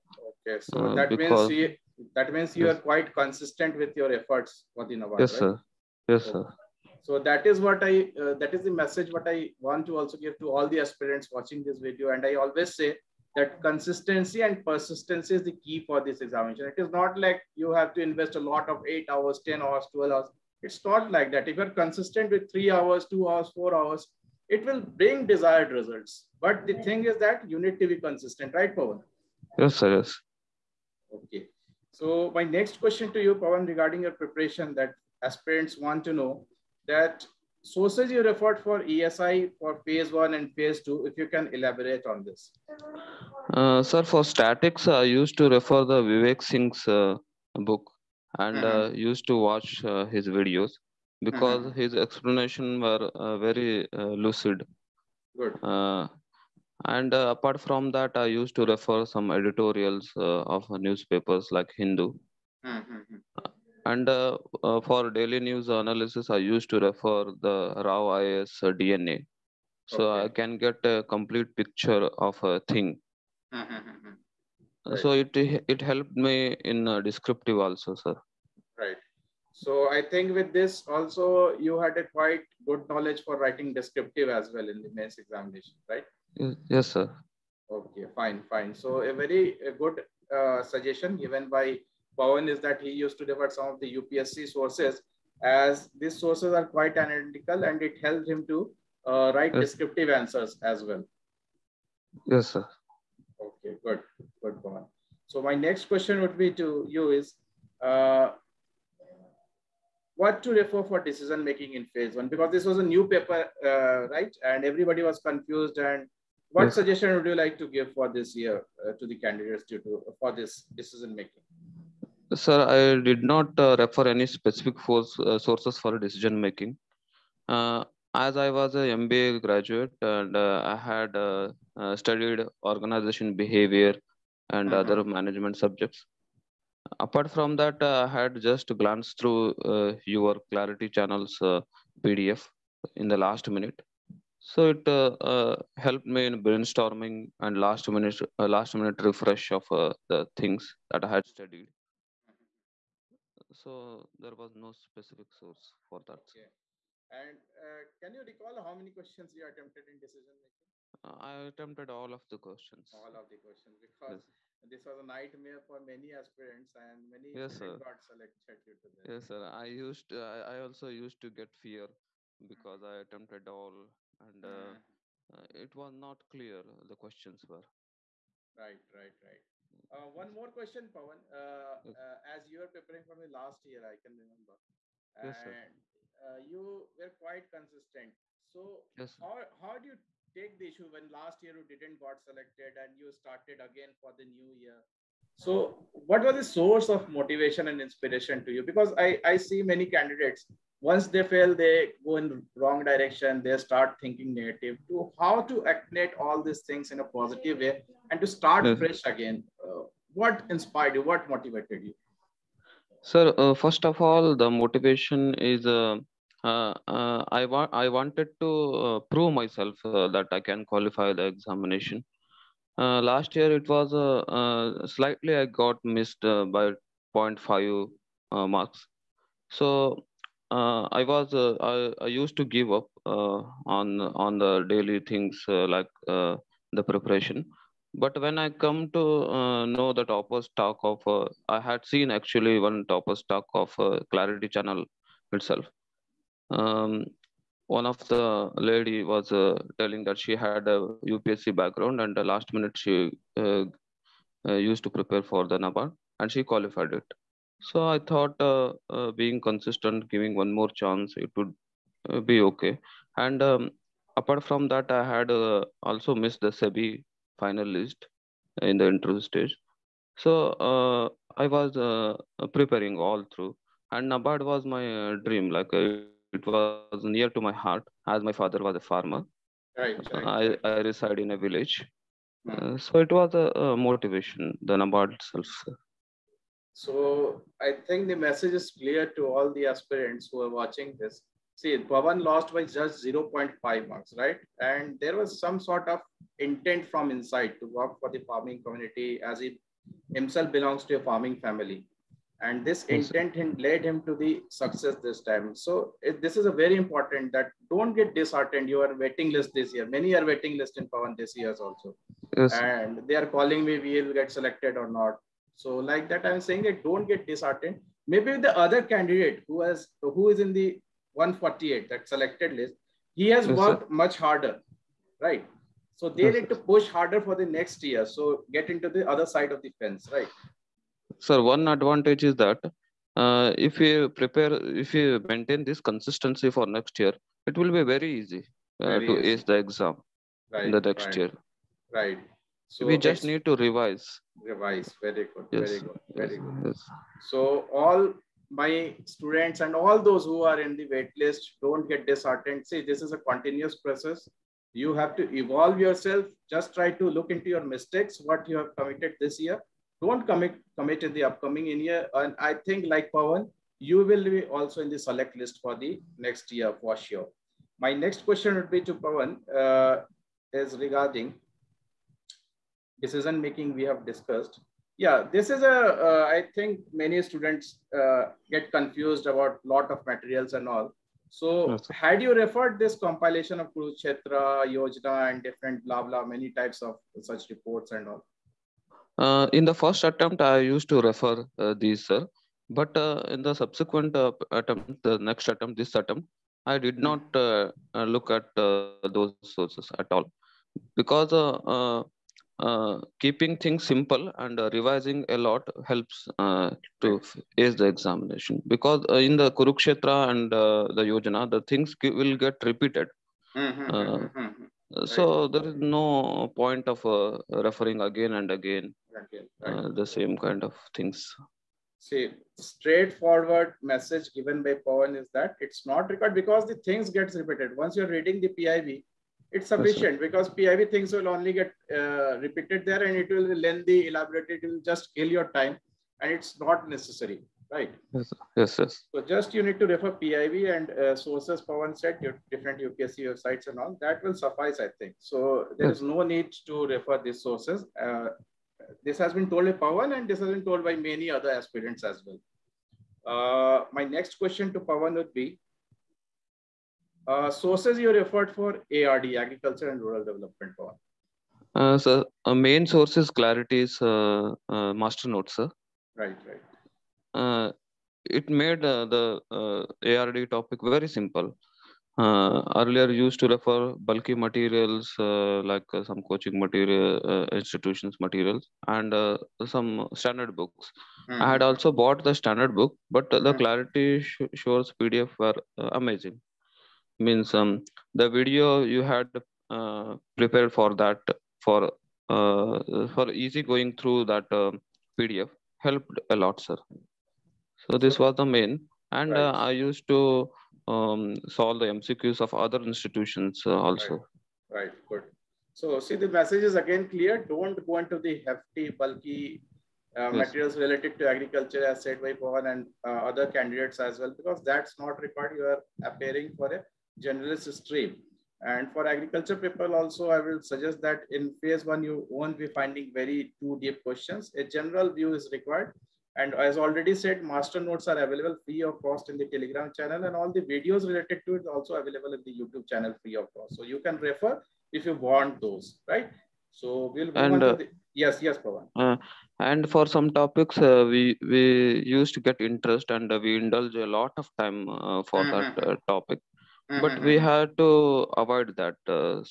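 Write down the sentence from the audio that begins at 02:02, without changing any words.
Sir, I did not uh, refer any specific force, uh, sources for decision making.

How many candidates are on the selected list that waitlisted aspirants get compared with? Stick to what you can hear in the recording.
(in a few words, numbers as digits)
148.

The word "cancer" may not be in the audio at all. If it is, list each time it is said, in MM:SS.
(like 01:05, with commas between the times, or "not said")
not said.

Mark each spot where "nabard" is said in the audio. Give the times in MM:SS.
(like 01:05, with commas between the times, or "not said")
04:15, 04:34, 04:44.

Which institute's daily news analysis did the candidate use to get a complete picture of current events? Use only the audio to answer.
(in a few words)
Rau's IAS.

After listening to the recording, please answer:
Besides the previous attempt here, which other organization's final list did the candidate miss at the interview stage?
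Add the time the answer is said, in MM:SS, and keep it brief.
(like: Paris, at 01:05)
SEBI, at 04:26.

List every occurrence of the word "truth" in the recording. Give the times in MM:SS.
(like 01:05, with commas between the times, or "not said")
not said.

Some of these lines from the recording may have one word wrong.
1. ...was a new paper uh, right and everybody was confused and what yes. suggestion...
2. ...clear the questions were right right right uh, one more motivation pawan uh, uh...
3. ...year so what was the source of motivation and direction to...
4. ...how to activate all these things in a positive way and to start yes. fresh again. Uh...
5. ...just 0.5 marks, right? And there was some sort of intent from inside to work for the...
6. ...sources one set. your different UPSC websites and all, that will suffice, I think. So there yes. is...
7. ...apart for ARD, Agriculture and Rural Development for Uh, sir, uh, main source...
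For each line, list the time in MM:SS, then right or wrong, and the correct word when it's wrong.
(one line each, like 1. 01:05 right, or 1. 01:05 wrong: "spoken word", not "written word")
1. 01:52 right
2. 02:56 wrong: "question", not "motivation"
3. 03:14 wrong: "inspiration", not "direction"
4. 03:25 right
5. 04:52 right
6. 07:21 right
7. 07:38 wrong: "effort", not "apart".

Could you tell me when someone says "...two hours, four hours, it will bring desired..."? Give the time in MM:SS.
00:23.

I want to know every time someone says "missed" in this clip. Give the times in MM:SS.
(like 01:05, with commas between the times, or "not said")
03:45, 04:26.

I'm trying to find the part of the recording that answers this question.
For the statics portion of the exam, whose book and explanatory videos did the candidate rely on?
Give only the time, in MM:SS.
00:46.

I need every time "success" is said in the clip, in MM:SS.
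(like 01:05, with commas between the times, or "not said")
05:04.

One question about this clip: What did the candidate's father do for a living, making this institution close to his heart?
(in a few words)
Farmer.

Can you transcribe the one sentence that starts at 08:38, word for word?
And for agriculture people also, I will suggest that in phase one, you won't be finding very too deep questions.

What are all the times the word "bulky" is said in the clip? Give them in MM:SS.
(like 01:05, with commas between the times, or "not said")
07:54, 08:28.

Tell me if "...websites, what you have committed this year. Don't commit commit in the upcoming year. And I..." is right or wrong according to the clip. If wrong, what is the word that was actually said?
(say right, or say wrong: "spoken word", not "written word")
wrong: "mistakes", not "websites".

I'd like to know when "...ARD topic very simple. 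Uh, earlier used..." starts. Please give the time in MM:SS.
07:50.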